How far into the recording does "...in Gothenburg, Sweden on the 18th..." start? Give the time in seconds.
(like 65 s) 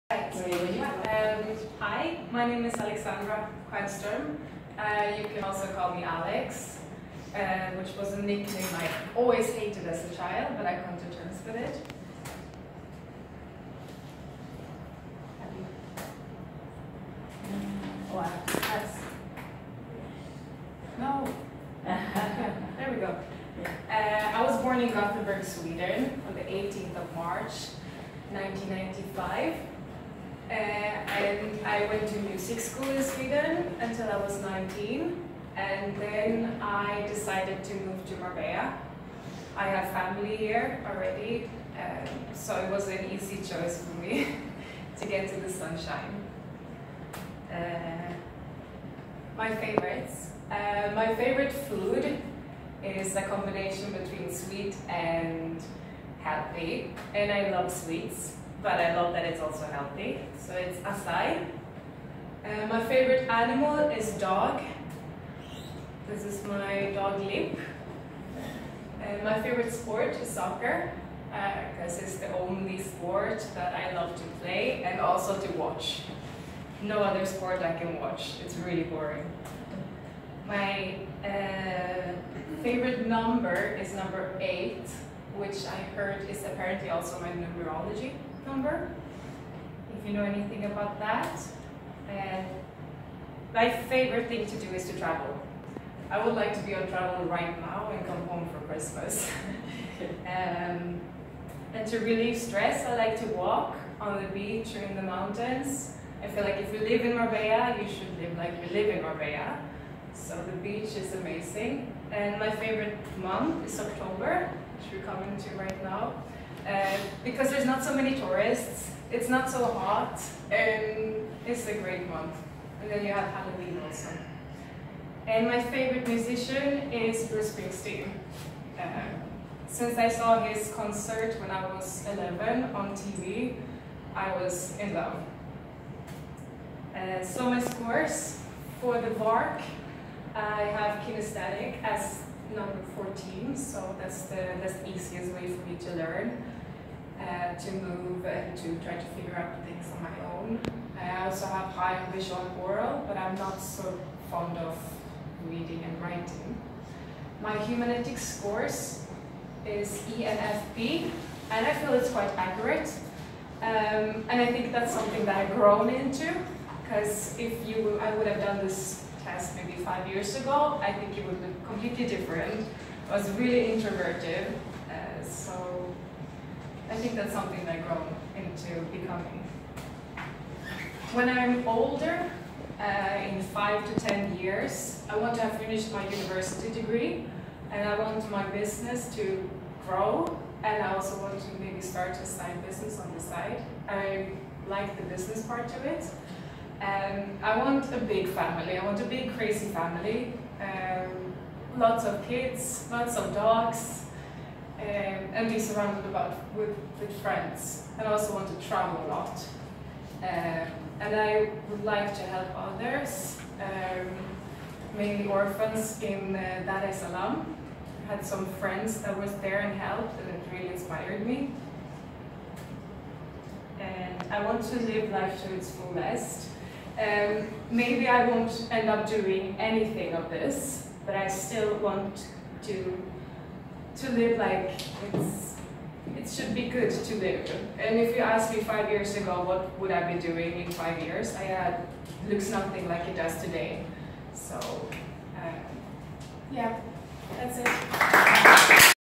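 24 s.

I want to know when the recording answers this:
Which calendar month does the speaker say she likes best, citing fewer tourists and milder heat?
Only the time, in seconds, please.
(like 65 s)
113 s.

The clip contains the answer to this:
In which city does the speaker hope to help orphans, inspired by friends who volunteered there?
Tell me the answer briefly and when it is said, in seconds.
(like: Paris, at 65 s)
Dar es Salaam, at 216 s.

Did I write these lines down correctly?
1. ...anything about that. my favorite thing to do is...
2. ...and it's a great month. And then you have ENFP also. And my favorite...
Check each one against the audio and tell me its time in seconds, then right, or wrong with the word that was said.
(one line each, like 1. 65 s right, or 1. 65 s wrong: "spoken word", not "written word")
1. 90 s right
2. 120 s wrong: "Halloween", not "ENFP".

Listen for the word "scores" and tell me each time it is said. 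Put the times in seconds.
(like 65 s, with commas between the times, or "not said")
137 s, 158 s.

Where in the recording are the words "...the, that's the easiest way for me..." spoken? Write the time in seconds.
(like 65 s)
144 s.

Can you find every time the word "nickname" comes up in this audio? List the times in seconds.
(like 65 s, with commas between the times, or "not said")
8 s.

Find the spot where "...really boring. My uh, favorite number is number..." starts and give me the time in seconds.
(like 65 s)
78 s.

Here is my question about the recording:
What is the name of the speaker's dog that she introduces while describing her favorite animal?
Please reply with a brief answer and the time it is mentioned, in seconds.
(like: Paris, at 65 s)
Limp, at 67 s.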